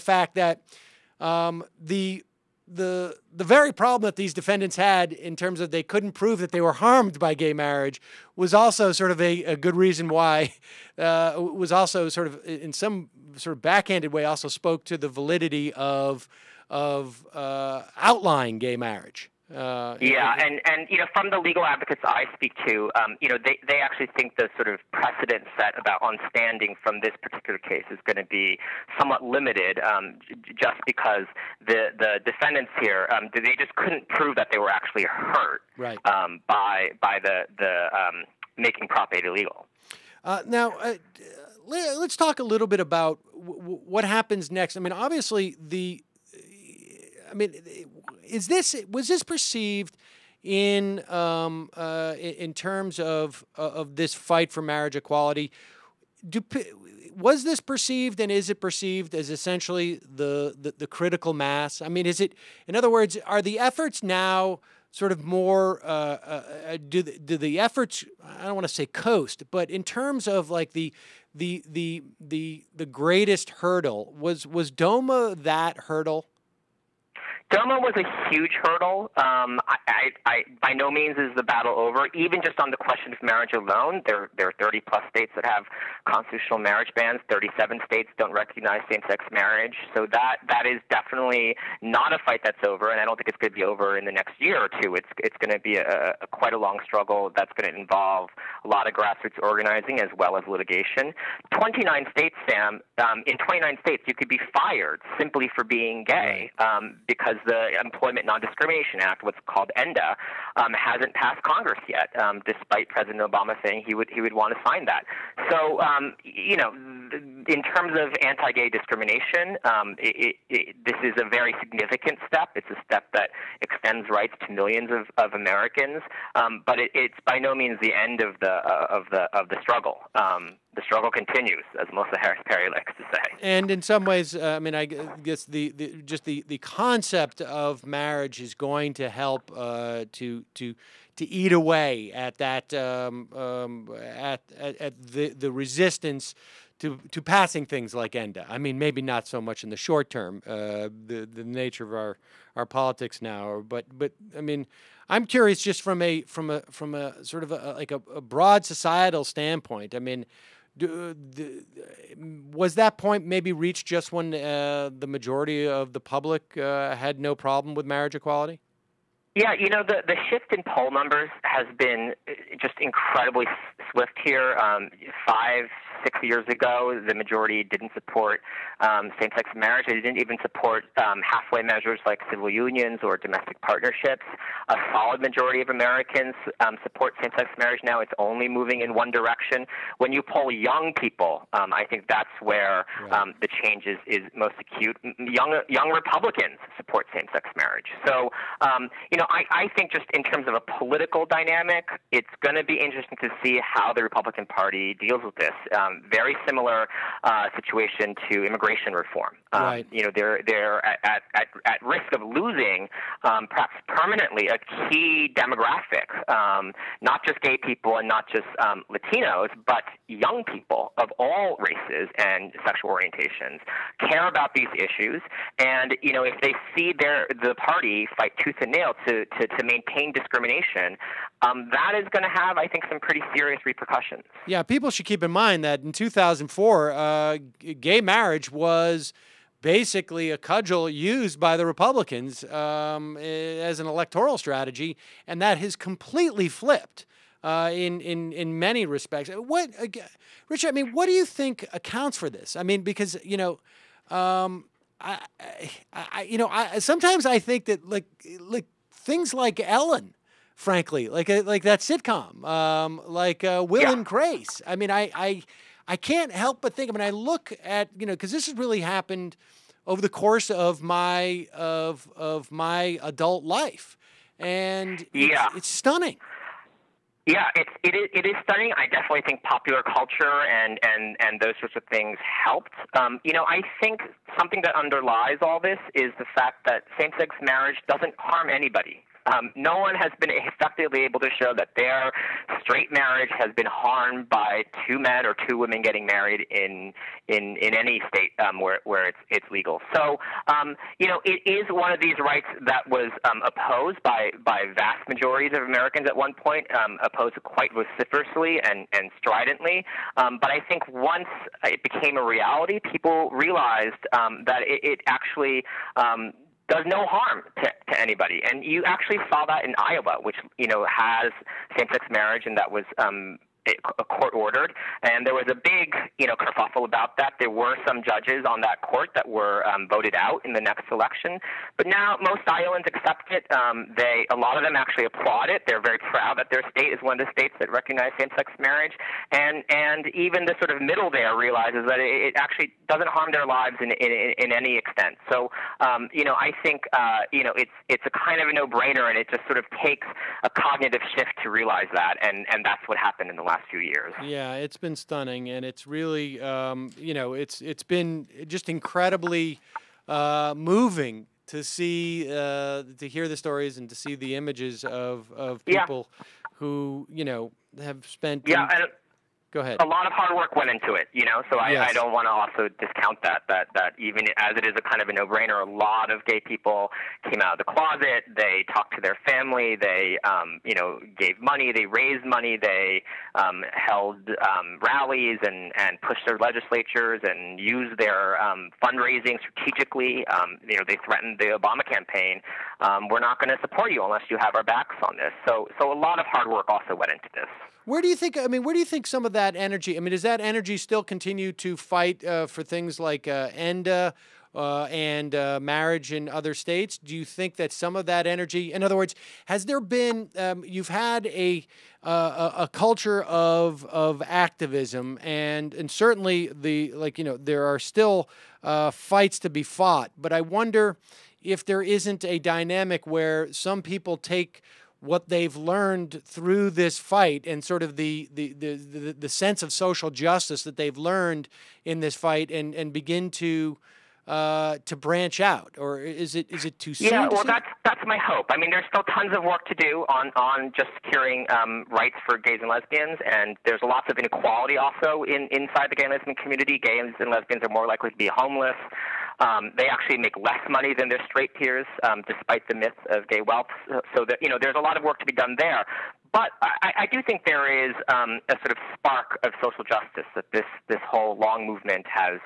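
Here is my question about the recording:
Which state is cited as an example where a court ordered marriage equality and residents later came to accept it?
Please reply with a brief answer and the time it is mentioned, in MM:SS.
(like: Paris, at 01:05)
Iowa, at 05:19.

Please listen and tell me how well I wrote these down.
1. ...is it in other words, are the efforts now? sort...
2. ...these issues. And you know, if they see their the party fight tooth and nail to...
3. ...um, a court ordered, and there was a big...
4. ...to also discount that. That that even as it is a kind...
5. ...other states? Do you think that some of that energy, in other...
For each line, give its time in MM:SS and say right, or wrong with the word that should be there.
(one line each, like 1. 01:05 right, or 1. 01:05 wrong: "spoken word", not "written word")
1. 01:02 right
2. 03:44 right
3. 05:22 right
4. 06:12 right
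5. 06:46 right.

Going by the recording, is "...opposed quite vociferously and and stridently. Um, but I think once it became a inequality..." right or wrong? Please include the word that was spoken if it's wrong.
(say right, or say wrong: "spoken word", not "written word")
wrong: "reality", not "inequality".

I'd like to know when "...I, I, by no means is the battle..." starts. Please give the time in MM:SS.
01:19.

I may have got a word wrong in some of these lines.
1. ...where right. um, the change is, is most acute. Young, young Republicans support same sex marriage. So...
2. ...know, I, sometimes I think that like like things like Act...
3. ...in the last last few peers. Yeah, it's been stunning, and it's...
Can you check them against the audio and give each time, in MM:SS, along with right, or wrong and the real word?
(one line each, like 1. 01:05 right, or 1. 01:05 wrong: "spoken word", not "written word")
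1. 03:12 right
2. 04:16 wrong: "Ellen", not "Act"
3. 05:53 wrong: "years", not "peers".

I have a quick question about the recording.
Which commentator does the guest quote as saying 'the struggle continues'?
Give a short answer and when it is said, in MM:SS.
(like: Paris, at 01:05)
Melissa Harris Perry, at 02:11.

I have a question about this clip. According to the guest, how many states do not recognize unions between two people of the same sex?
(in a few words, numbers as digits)
37.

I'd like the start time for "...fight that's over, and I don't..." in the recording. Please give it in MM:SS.
01:32.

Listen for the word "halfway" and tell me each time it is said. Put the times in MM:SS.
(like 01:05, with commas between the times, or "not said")
03:01.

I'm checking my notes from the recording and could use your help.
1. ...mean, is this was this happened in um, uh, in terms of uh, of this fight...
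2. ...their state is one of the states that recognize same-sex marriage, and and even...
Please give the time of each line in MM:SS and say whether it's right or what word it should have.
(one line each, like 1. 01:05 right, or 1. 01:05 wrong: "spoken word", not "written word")
1. 00:47 wrong: "perceived", not "happened"
2. 05:36 right.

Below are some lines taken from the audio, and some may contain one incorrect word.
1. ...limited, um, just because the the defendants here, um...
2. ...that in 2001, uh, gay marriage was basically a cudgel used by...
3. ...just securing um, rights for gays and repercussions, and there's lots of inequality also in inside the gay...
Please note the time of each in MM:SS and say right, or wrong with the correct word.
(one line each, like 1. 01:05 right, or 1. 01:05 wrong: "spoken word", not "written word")
1. 00:29 right
2. 03:55 wrong: "2004", not "2001"
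3. 07:20 wrong: "lesbians", not "repercussions".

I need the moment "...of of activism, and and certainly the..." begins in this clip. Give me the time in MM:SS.
06:53.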